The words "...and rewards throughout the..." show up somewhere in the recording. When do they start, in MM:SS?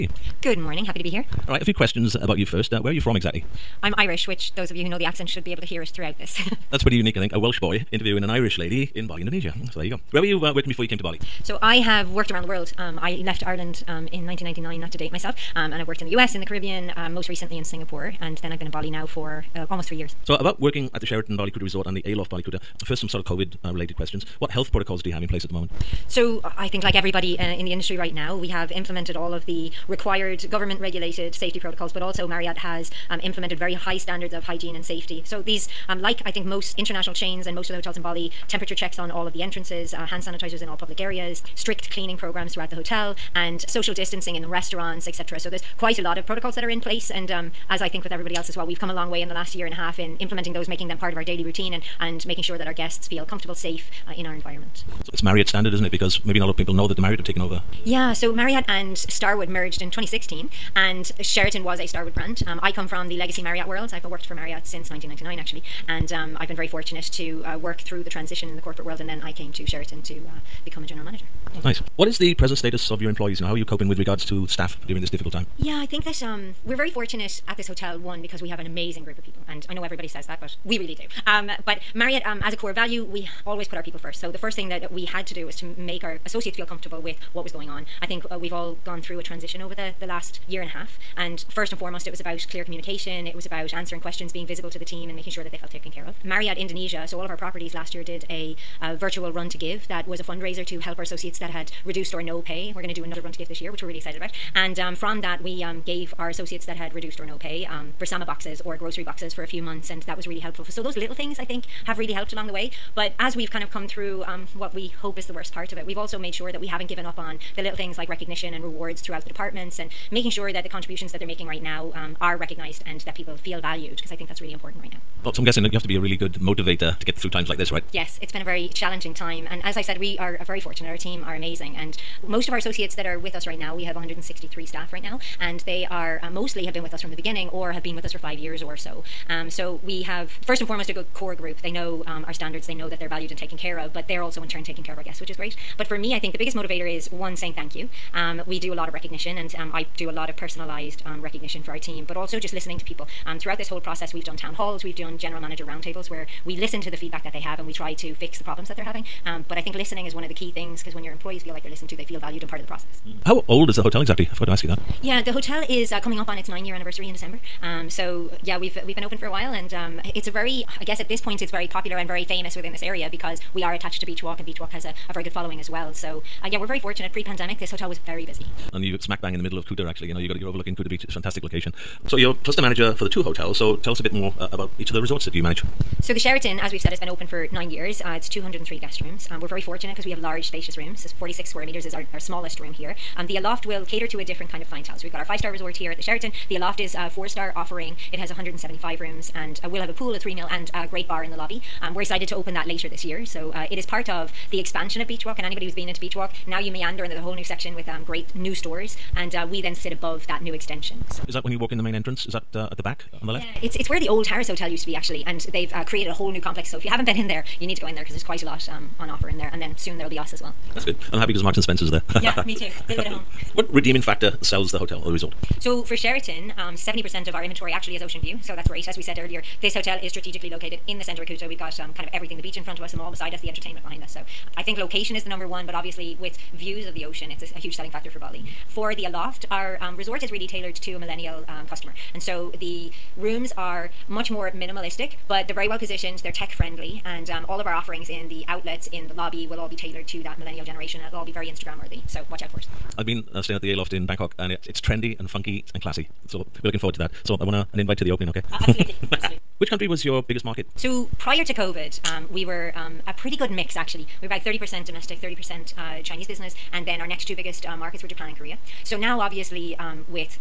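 01:58.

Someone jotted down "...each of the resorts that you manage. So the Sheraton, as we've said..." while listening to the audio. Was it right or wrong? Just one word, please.
right.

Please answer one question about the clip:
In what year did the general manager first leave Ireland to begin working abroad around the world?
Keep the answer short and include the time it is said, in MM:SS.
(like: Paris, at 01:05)
1999, at 00:14.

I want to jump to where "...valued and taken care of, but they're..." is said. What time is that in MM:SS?
02:23.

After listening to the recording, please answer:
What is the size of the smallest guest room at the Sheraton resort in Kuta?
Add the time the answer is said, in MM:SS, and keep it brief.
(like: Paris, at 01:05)
46 square meters, at 03:11.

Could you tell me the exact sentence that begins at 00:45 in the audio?
So there's quite a lot of protocols that are in place.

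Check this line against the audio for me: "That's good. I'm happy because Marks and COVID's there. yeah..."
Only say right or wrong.
wrong.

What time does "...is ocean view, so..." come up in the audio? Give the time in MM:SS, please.
03:47.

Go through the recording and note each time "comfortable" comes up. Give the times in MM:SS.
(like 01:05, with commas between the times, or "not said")
00:53, 01:26.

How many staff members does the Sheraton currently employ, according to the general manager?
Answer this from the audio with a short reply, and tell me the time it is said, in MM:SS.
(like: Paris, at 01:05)
163, at 02:13.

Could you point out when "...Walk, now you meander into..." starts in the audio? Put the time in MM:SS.
03:26.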